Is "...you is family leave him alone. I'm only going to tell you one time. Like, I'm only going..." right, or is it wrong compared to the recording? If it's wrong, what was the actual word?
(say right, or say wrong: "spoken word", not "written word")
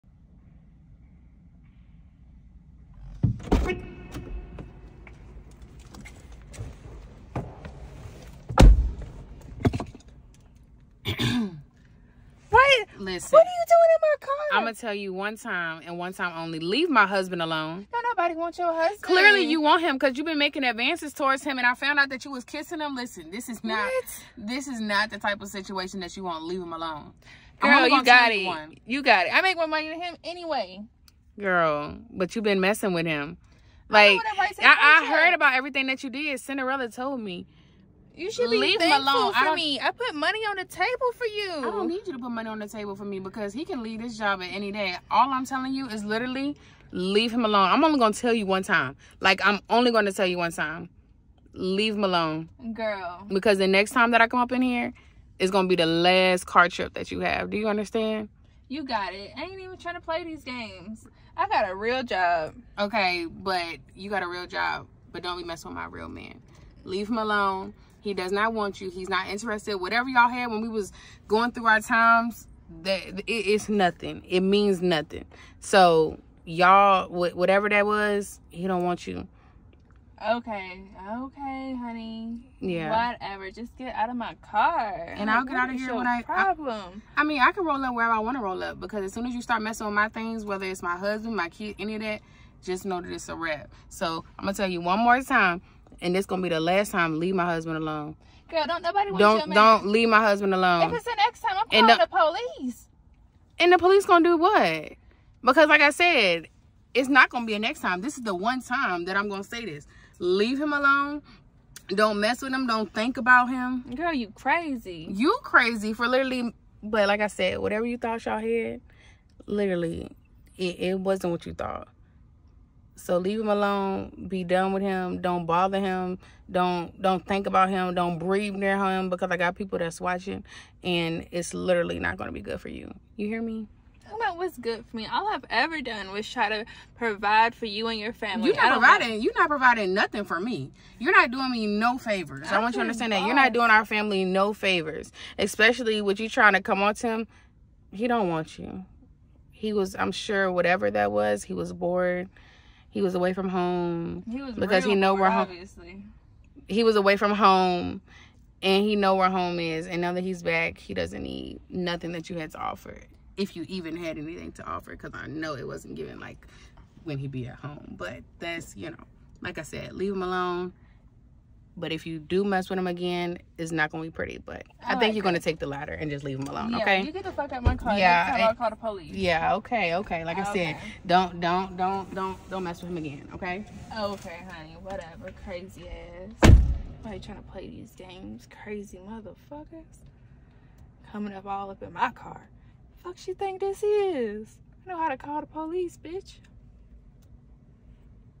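wrong: "literally", not "family".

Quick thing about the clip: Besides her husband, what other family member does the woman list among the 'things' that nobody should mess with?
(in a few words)
kid.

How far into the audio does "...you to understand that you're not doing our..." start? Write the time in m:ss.
2:22.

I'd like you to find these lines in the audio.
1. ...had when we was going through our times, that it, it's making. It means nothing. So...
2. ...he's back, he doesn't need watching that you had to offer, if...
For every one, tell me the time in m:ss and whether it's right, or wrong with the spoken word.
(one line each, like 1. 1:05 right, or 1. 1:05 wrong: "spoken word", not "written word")
1. 1:10 wrong: "nothing", not "making"
2. 2:40 wrong: "nothing", not "watching".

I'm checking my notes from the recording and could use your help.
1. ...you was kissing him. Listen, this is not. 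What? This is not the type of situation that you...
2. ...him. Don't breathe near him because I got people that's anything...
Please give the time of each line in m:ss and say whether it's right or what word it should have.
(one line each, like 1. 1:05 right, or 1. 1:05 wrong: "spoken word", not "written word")
1. 0:22 right
2. 2:07 wrong: "watching", not "anything".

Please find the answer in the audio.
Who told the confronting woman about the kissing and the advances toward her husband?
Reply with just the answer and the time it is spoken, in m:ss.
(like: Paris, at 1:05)
Cinderella, at 0:36.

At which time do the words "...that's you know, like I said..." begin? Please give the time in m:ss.
2:48.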